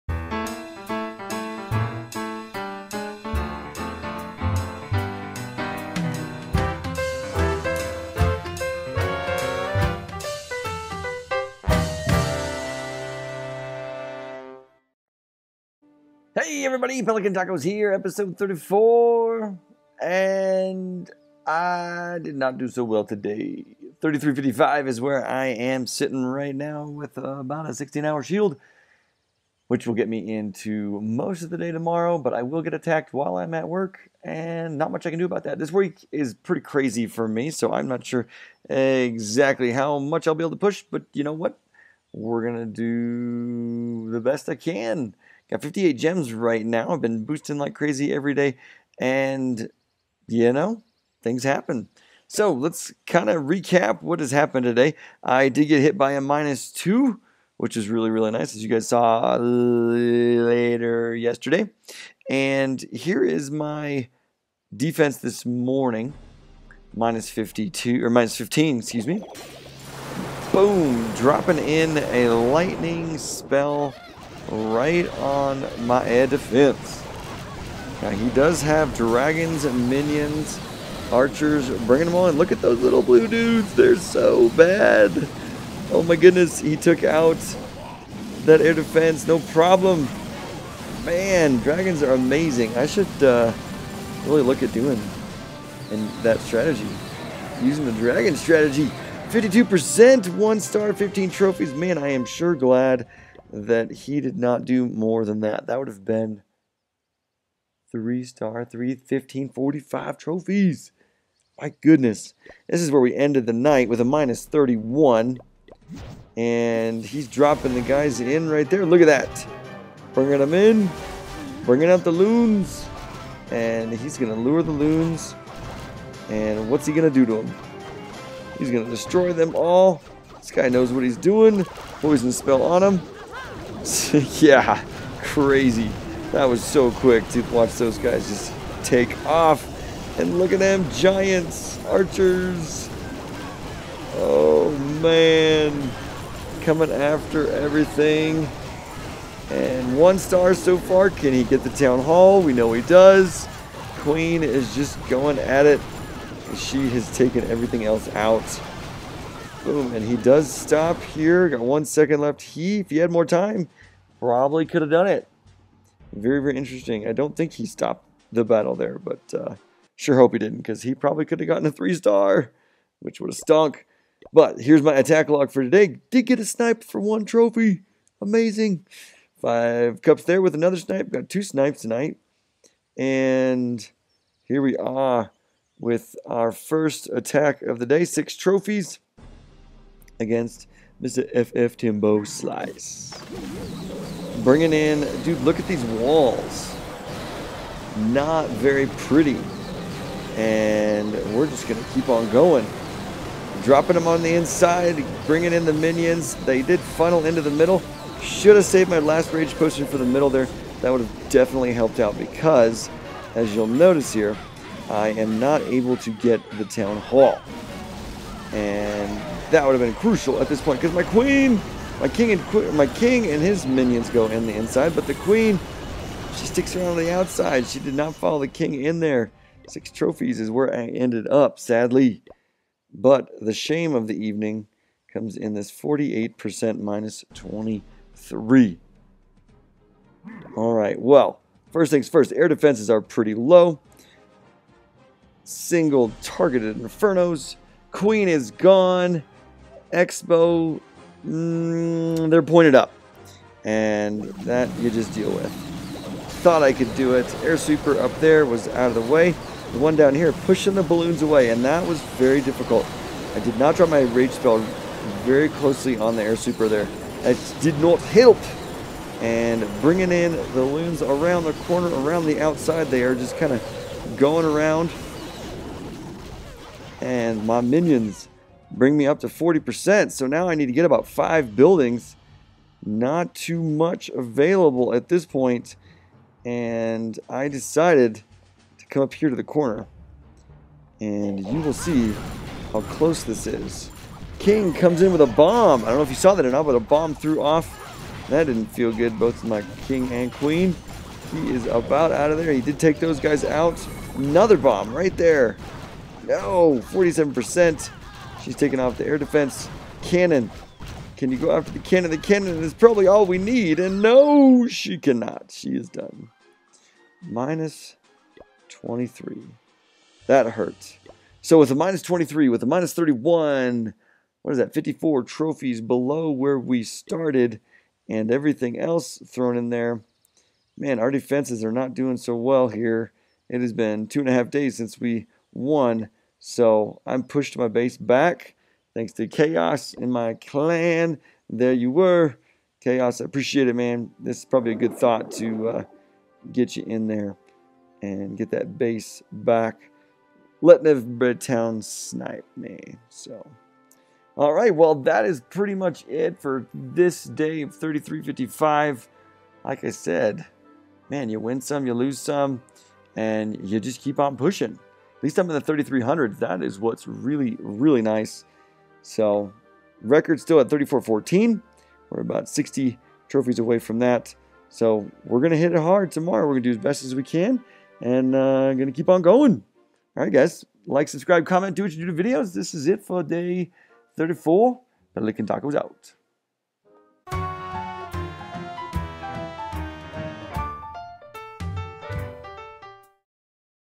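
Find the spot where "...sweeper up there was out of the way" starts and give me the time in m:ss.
4:17.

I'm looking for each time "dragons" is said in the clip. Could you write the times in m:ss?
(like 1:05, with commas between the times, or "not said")
1:18, 1:31, 1:37.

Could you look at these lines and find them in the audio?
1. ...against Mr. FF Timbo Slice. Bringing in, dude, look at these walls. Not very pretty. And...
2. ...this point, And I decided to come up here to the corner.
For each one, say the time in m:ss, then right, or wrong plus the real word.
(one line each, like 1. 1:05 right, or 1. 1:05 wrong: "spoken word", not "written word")
1. 3:10 right
2. 4:45 right.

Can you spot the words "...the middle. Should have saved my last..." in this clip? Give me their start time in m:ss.
3:27.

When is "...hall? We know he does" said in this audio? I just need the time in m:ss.
2:32.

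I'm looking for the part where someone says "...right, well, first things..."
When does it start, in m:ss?
4:00.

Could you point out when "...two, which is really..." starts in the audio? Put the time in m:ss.
0:56.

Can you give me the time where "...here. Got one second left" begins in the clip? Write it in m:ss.
2:41.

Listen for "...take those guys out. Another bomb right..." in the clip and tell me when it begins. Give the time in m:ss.
5:02.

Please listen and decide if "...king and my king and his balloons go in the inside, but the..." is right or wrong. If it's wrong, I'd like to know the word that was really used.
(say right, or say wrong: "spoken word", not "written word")
wrong: "minions", not "balloons".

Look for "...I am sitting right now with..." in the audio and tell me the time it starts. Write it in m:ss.
0:25.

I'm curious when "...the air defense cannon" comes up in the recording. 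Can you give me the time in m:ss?
5:08.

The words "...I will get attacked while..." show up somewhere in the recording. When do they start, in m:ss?
0:32.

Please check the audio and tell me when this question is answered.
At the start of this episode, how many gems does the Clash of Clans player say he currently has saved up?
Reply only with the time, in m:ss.
0:45.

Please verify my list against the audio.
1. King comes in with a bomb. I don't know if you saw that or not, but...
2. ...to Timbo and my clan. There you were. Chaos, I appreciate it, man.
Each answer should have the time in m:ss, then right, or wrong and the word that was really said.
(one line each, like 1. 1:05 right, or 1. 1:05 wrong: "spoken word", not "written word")
1. 4:54 right
2. 5:39 wrong: "Chaos", not "Timbo".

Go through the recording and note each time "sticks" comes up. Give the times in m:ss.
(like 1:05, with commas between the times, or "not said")
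3:46.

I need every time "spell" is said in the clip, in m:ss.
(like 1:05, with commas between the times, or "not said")
1:13, 2:12, 4:24.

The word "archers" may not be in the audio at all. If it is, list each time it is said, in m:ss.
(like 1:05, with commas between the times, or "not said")
1:21, 2:21.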